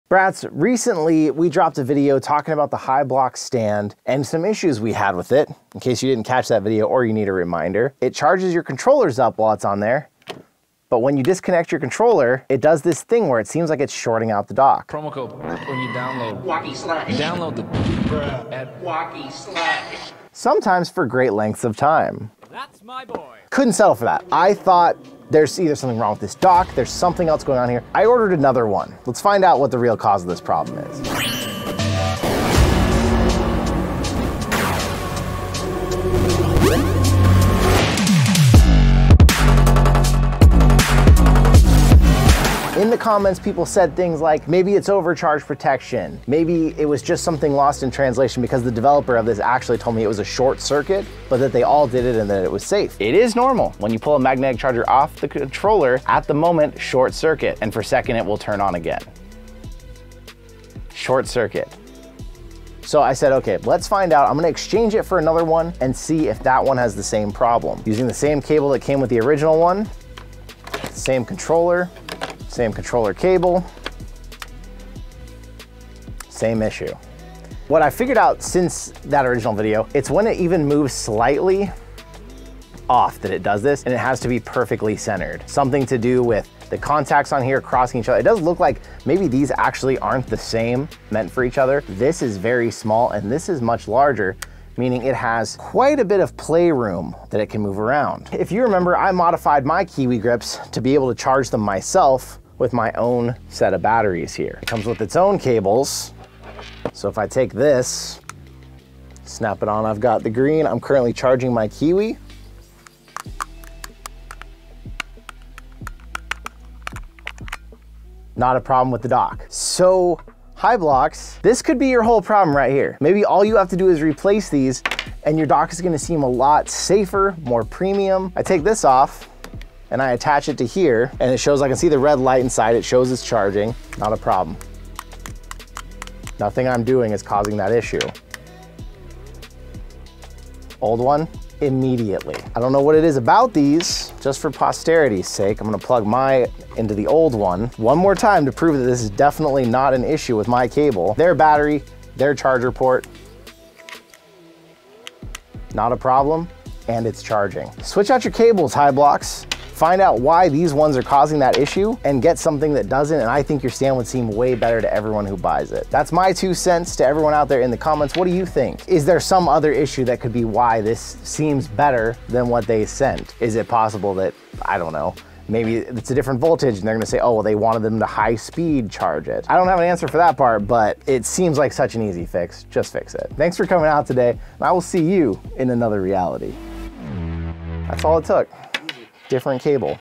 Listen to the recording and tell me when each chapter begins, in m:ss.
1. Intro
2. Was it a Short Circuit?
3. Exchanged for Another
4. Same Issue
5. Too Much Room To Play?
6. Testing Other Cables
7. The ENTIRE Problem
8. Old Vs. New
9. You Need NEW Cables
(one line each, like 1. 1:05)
1. 0:30
2. 0:43
3. 1:05
4. 1:17
5. 1:35
6. 1:47
7. 2:00
8. 2:15
9. 2:38.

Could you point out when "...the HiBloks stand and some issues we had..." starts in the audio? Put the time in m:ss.
0:02.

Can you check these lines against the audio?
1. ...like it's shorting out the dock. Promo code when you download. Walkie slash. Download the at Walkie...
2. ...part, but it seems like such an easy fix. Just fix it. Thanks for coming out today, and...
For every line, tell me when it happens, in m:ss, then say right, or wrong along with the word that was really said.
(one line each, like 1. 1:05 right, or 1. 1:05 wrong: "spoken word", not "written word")
1. 0:13 right
2. 3:00 right.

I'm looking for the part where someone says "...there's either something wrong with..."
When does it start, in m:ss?
0:25.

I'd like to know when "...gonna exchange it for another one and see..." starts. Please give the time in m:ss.
1:04.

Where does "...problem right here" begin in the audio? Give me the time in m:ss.
2:02.